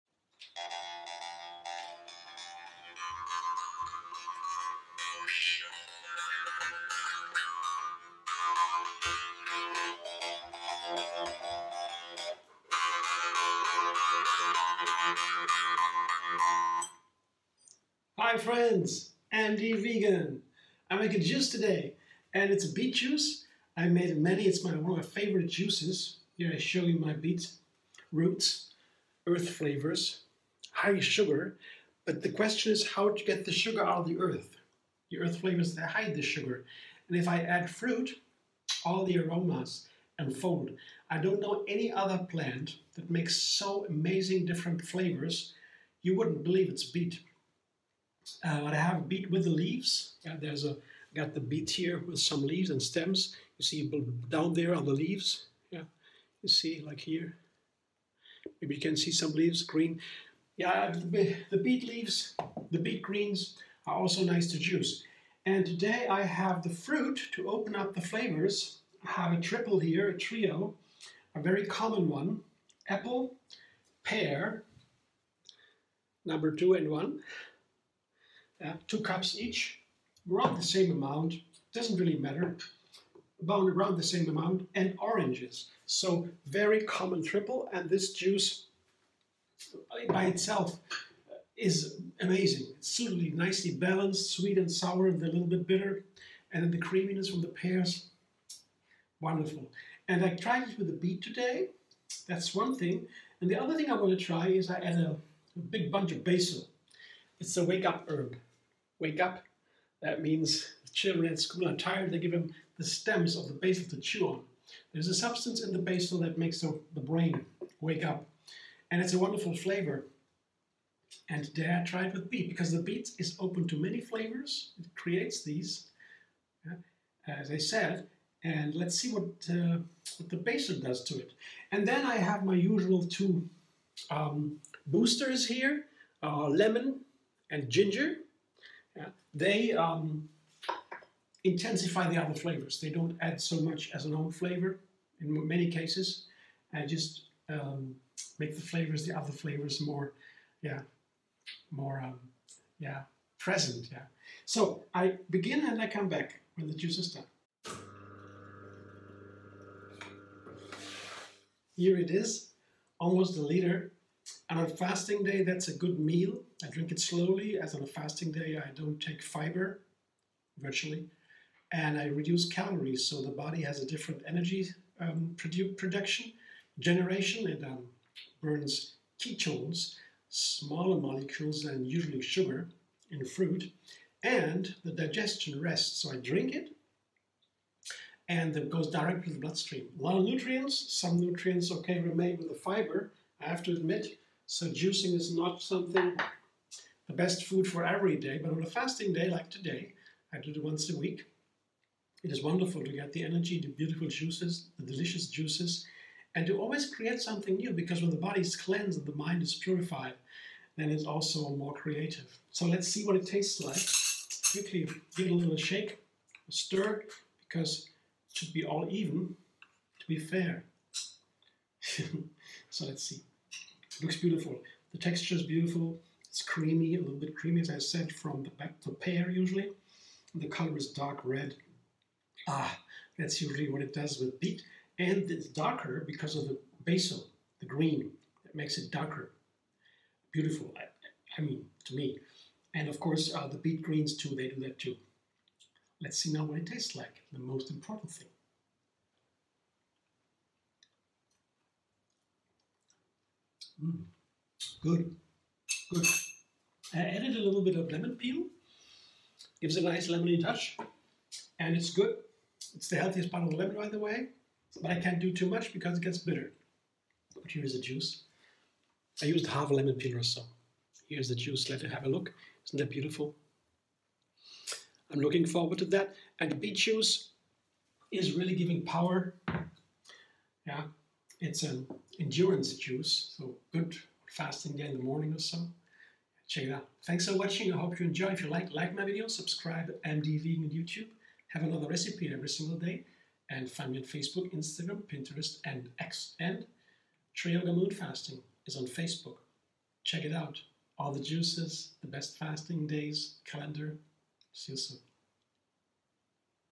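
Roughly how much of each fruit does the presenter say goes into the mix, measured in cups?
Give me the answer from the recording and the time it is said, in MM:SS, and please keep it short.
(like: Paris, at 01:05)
2 cups, at 01:18.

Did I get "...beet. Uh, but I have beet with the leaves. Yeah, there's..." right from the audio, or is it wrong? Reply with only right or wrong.
right.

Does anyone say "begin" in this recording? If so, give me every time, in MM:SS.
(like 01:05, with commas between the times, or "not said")
02:35.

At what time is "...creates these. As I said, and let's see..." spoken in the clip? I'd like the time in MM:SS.
02:04.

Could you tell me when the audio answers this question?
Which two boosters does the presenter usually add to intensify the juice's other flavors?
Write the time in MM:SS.
02:16.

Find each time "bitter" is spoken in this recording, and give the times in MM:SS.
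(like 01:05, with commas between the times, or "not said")
01:35, 04:26.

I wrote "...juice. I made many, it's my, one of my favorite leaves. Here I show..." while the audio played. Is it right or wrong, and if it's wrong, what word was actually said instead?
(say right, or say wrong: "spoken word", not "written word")
wrong: "juices", not "leaves".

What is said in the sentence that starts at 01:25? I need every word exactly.
So very common triple, and this juice by itself uh, is amazing.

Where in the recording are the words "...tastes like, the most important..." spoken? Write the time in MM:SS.
04:06.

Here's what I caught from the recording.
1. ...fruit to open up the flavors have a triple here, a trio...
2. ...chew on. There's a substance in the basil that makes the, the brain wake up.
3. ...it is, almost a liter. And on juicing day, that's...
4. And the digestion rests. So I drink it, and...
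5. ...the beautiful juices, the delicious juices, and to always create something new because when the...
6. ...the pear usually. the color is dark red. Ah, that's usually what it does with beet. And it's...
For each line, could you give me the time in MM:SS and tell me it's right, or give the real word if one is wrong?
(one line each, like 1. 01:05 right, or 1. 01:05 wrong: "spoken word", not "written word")
1. 01:06 right
2. 01:53 right
3. 02:41 wrong: "fasting", not "juicing"
4. 03:04 right
5. 03:23 right
6. 03:48 right.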